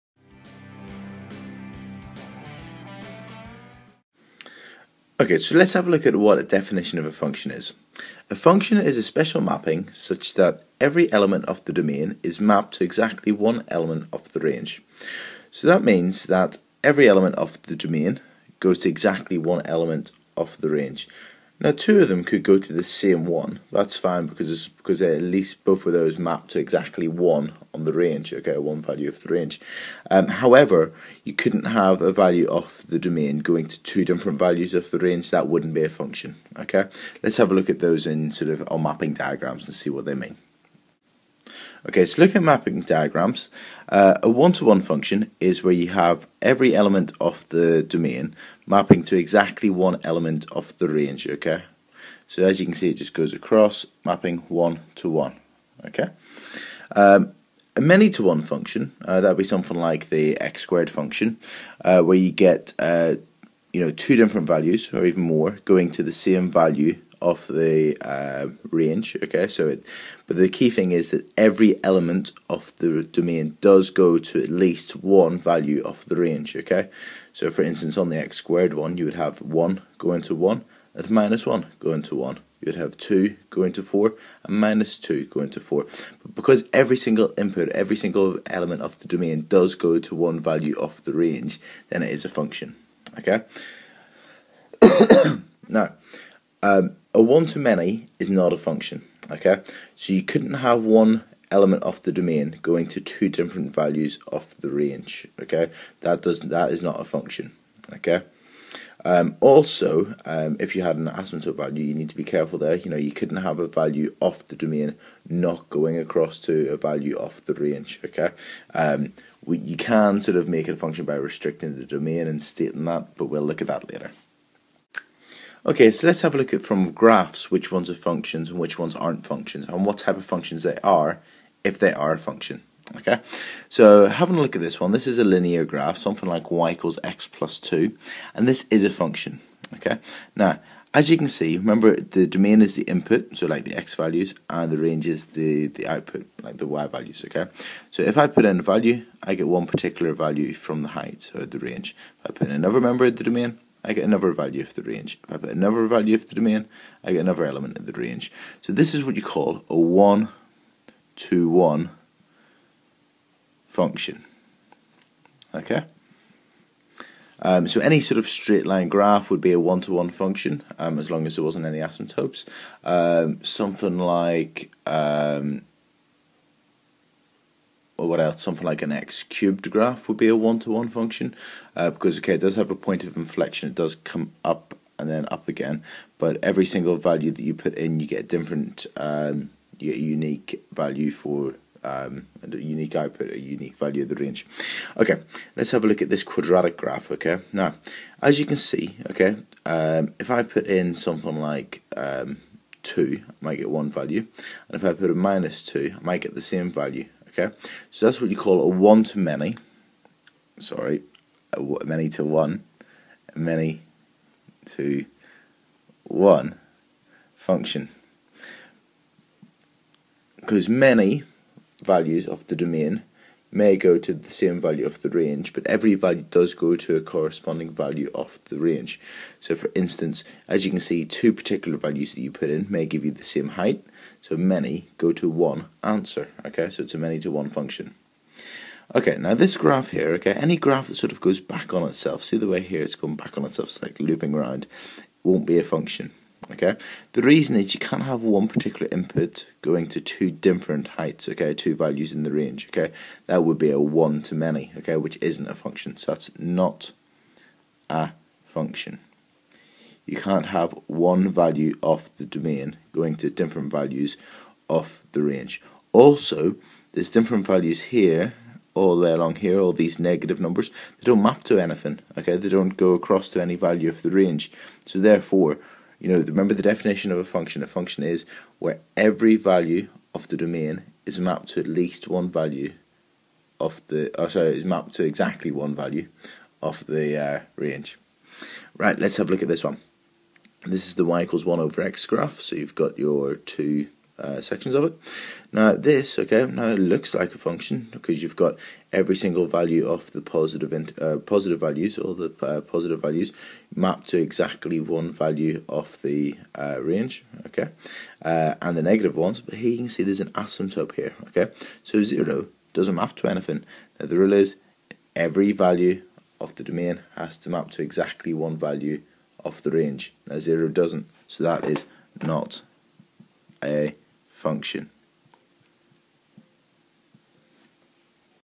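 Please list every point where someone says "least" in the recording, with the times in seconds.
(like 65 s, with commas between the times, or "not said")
25 s, 74 s, 281 s.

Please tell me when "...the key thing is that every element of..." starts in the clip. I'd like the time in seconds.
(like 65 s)
70 s.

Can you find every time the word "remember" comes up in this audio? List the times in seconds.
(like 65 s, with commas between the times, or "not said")
141 s, 276 s.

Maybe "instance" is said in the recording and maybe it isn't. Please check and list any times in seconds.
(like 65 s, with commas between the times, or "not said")
77 s, 229 s.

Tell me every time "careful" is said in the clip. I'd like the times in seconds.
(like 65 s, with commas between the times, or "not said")
112 s.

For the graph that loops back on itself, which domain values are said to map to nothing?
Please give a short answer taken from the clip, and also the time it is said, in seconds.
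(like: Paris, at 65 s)
negative numbers, at 269 s.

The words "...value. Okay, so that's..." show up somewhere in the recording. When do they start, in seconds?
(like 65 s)
206 s.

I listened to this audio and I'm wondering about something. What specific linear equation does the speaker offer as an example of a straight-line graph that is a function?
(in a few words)
y = x + 2.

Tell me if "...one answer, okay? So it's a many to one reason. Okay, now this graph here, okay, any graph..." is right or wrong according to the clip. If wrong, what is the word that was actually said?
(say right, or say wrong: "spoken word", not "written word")
wrong: "function", not "reason".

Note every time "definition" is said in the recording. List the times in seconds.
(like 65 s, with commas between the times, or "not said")
6 s, 276 s.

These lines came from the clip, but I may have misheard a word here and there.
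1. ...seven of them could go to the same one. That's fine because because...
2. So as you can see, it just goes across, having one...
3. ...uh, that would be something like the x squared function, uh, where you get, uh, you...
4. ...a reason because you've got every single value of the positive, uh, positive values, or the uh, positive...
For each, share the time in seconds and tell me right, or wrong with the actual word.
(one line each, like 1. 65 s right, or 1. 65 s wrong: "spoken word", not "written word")
1. 21 s wrong: "two", not "seven"
2. 52 s wrong: "mapping", not "having"
3. 59 s right
4. 297 s wrong: "function", not "reason".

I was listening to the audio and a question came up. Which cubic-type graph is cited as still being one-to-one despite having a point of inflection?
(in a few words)
x cubed.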